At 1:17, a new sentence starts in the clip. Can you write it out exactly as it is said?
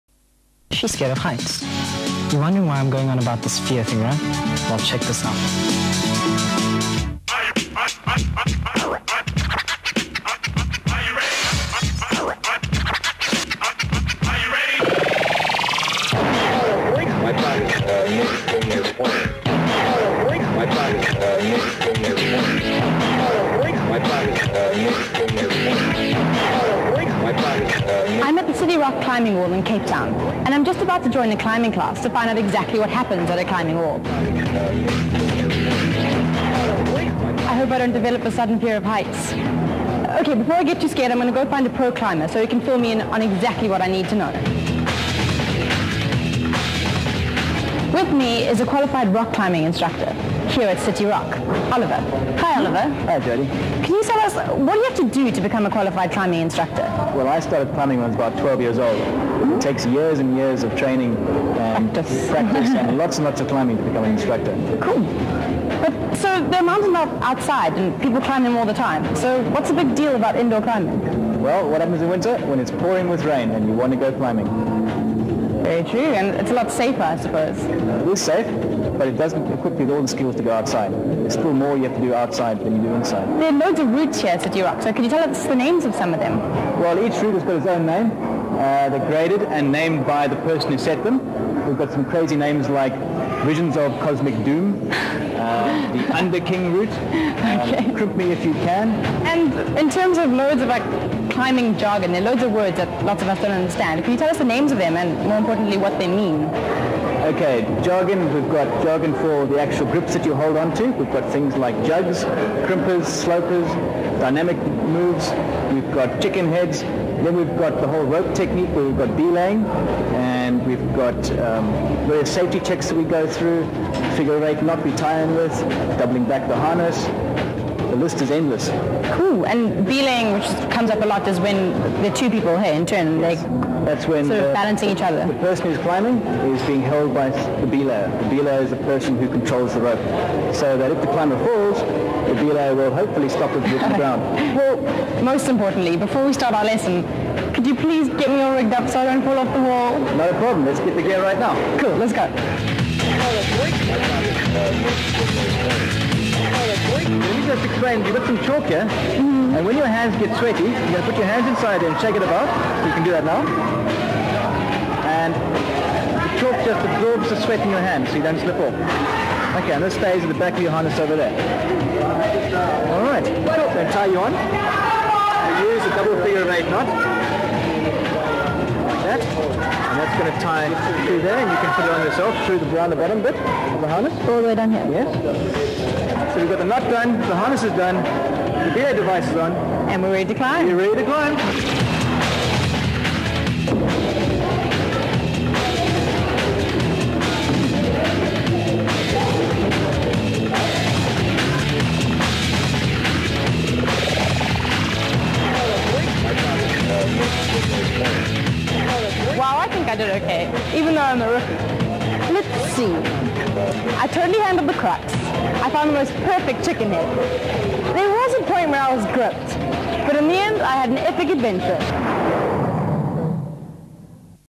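It is safe, but it doesn't equip you with all the skills to go outside.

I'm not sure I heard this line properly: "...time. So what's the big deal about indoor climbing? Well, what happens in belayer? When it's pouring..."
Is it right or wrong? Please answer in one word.
wrong.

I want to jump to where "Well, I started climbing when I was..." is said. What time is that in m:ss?
0:57.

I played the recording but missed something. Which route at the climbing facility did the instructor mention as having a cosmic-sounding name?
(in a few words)
Visions of Cosmic Doom.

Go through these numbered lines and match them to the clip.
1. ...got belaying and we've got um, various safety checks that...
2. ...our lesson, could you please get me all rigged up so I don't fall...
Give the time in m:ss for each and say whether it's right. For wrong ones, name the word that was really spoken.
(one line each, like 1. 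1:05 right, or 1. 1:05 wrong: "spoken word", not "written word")
1. 1:58 right
2. 2:26 right.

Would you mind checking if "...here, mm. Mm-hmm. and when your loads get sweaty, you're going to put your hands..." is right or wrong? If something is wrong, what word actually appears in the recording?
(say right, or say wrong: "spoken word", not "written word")
wrong: "hands", not "loads".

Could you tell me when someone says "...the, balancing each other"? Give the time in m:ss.
2:14.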